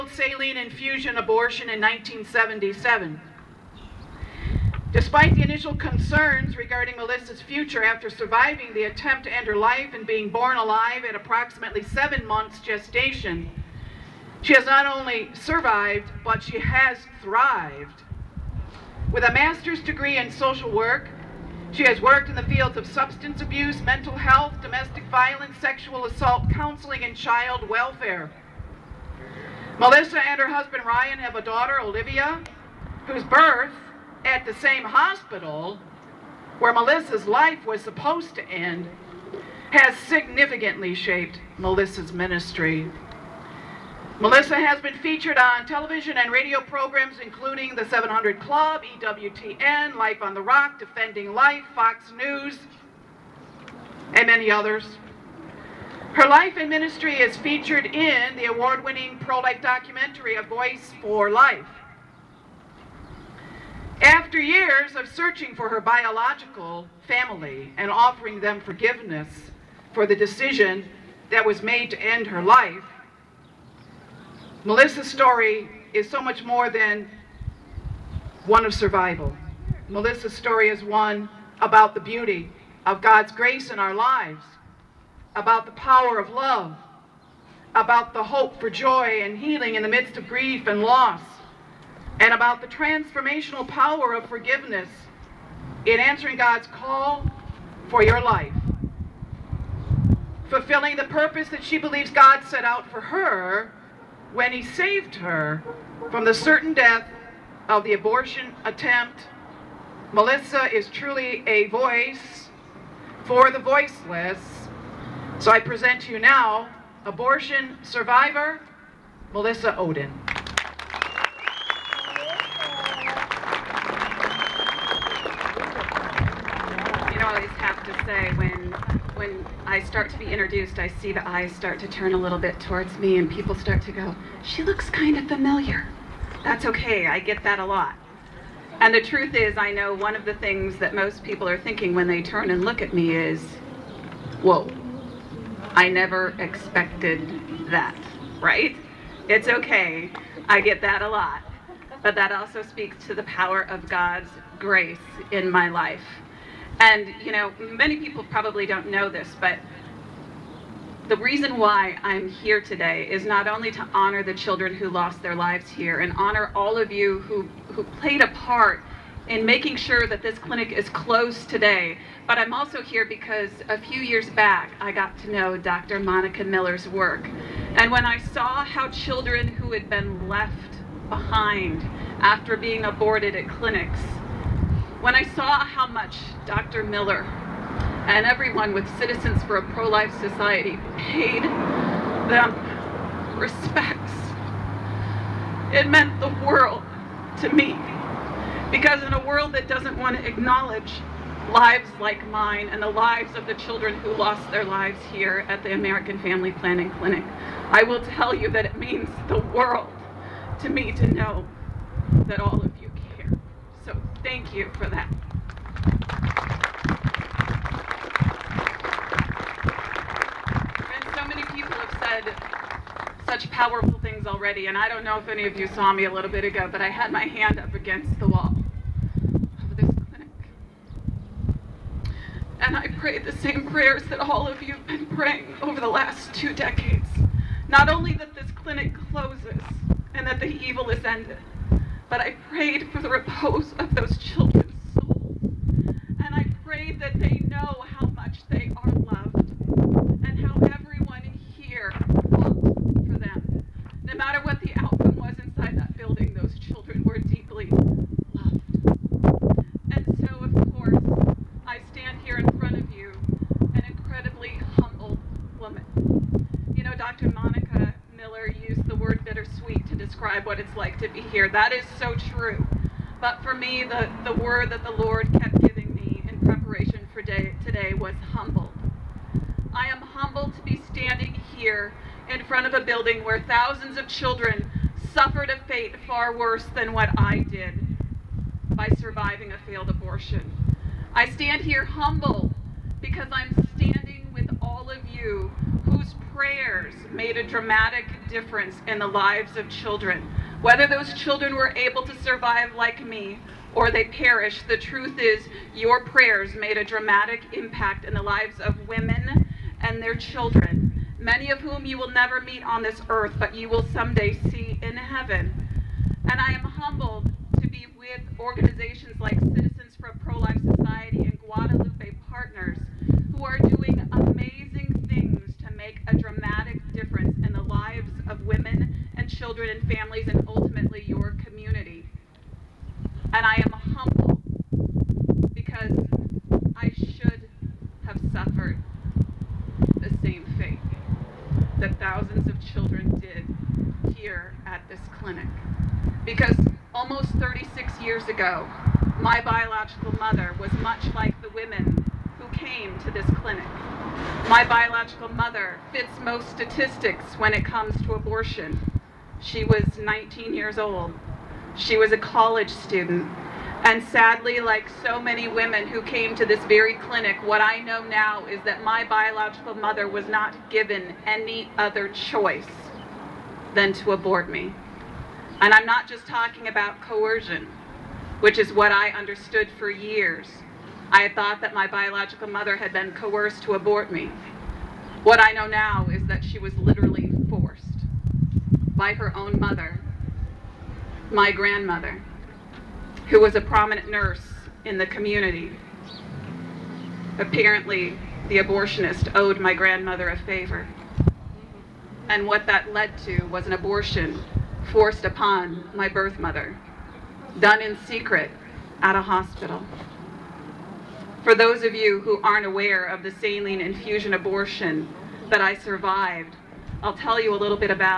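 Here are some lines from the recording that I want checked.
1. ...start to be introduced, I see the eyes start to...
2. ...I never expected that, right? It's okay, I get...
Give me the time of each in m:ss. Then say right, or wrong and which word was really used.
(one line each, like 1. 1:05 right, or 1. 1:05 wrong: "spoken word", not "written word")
1. 2:09 right
2. 2:25 right.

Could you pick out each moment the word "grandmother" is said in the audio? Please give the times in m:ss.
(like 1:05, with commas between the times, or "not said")
6:31, 6:39.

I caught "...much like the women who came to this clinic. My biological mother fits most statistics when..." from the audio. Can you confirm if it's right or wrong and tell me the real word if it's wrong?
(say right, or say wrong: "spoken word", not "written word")
right.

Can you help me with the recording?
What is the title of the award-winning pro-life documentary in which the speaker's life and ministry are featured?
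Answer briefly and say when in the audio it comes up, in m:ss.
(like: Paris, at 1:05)
A Voice for Life, at 1:00.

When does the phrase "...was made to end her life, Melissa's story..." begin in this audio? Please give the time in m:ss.
1:11.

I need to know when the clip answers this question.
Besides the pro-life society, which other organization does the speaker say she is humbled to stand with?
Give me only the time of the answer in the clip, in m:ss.
5:21.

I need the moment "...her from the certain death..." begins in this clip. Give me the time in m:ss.
1:45.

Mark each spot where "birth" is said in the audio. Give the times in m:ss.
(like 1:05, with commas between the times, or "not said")
0:33, 6:46.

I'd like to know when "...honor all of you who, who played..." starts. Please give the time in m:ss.
2:46.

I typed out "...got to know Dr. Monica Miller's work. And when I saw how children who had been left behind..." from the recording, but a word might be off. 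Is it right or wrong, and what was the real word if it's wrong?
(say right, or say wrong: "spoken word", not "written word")
right.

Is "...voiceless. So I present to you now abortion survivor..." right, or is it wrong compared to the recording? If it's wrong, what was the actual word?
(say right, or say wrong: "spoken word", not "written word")
right.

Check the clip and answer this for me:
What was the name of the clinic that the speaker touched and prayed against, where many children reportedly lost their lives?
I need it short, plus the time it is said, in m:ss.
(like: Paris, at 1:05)
American Family Planning Clinic, at 3:25.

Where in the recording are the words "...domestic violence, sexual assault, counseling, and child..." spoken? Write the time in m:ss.
0:24.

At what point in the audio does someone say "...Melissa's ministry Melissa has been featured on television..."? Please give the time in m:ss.
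0:41.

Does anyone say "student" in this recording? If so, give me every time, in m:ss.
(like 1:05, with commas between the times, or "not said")
6:02.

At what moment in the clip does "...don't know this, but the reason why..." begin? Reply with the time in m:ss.
2:38.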